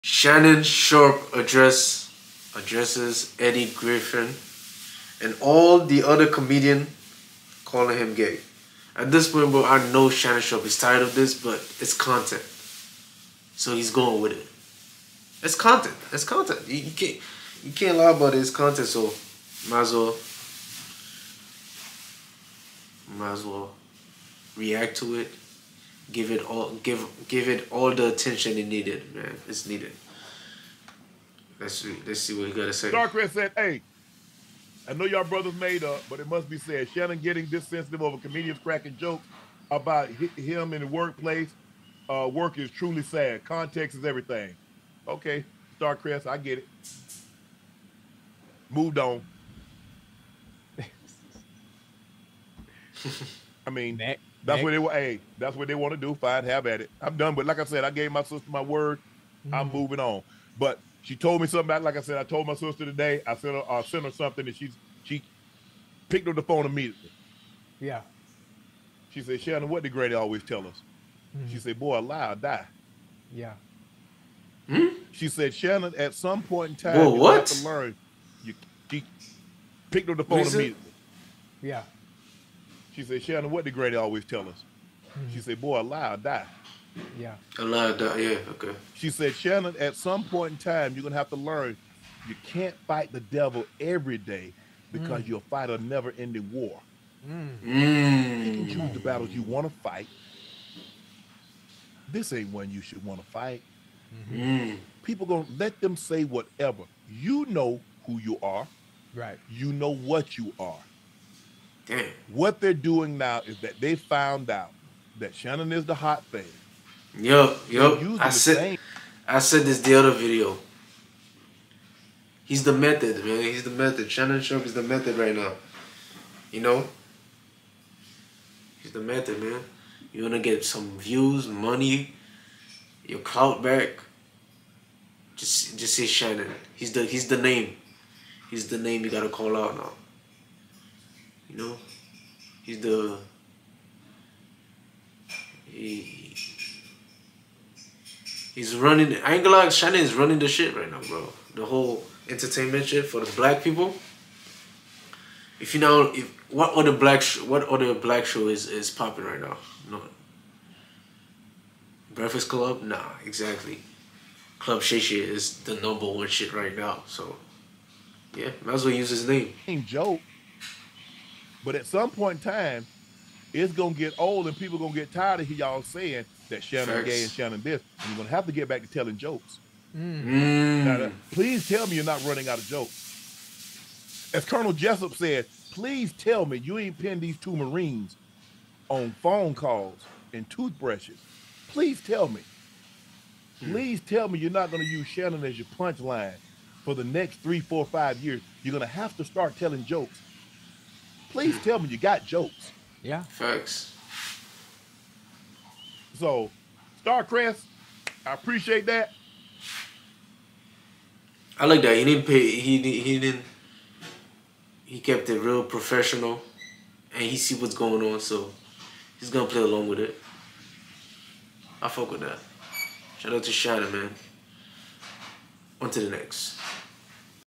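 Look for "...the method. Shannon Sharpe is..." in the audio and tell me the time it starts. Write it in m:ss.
2:03.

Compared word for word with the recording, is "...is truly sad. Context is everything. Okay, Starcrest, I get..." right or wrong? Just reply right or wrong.
right.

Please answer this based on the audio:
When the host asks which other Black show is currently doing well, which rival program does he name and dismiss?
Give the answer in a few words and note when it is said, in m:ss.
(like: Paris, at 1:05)
Breakfast Club, at 2:42.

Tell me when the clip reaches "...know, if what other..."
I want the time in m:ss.
2:35.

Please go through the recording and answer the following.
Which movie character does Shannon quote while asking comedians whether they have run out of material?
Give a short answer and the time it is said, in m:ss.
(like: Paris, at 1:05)
Colonel Jessup, at 3:04.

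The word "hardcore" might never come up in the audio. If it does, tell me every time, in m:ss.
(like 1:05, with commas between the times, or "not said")
not said.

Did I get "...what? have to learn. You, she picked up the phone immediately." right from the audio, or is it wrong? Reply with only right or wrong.
right.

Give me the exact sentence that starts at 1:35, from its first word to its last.
you'll fight a never ending war.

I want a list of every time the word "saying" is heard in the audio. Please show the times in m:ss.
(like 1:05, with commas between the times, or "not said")
2:55.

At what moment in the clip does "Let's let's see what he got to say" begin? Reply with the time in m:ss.
0:31.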